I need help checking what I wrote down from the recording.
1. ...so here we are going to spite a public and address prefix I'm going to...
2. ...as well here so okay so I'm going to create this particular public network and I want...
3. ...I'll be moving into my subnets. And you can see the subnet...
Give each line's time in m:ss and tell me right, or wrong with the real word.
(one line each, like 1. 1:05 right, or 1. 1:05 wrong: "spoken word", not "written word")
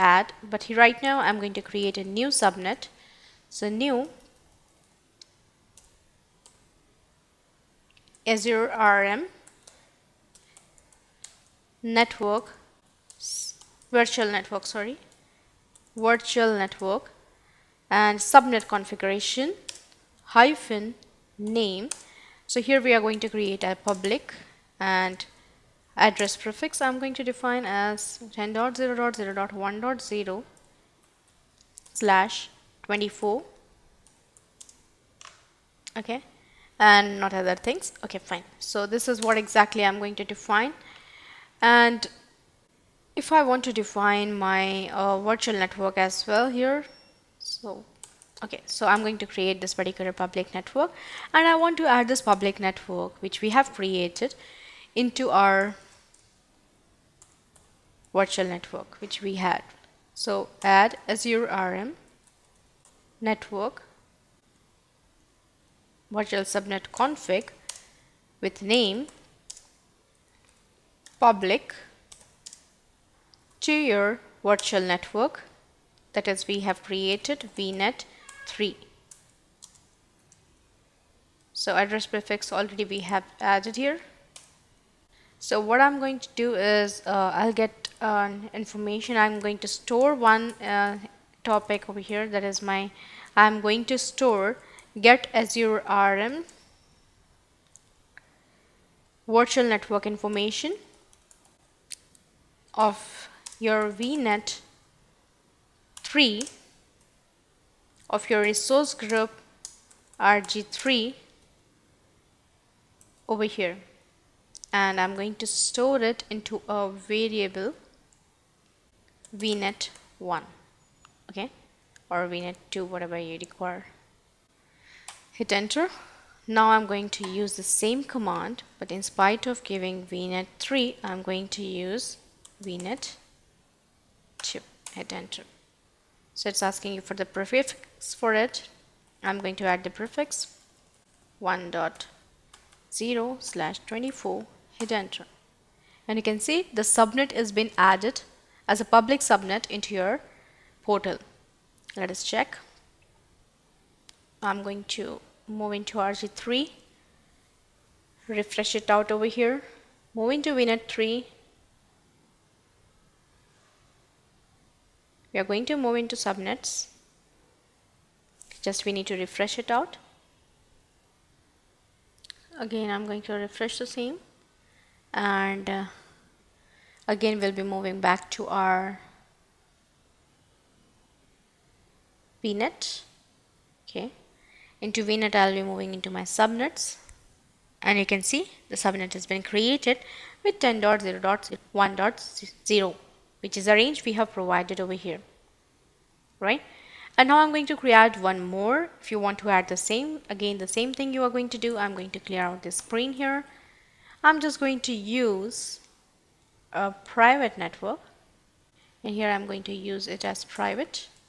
1. 0:22 wrong: "create", not "spite"
2. 0:45 right
3. 3:05 right.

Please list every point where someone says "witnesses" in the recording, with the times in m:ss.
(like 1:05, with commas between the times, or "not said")
not said.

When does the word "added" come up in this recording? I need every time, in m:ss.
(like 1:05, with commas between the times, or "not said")
1:23, 2:27.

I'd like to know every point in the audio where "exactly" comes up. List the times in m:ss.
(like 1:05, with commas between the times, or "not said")
0:39.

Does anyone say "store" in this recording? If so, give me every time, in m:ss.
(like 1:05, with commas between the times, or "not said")
1:29, 1:33, 1:55.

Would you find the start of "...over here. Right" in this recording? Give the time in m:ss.
3:14.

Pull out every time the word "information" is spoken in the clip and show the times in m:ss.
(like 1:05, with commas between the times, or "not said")
1:28, 1:40.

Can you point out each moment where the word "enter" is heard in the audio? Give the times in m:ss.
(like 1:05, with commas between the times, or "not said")
2:05, 2:15, 2:24.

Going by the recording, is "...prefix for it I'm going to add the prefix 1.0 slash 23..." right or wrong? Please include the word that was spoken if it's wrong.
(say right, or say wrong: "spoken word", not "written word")
wrong: "24", not "23".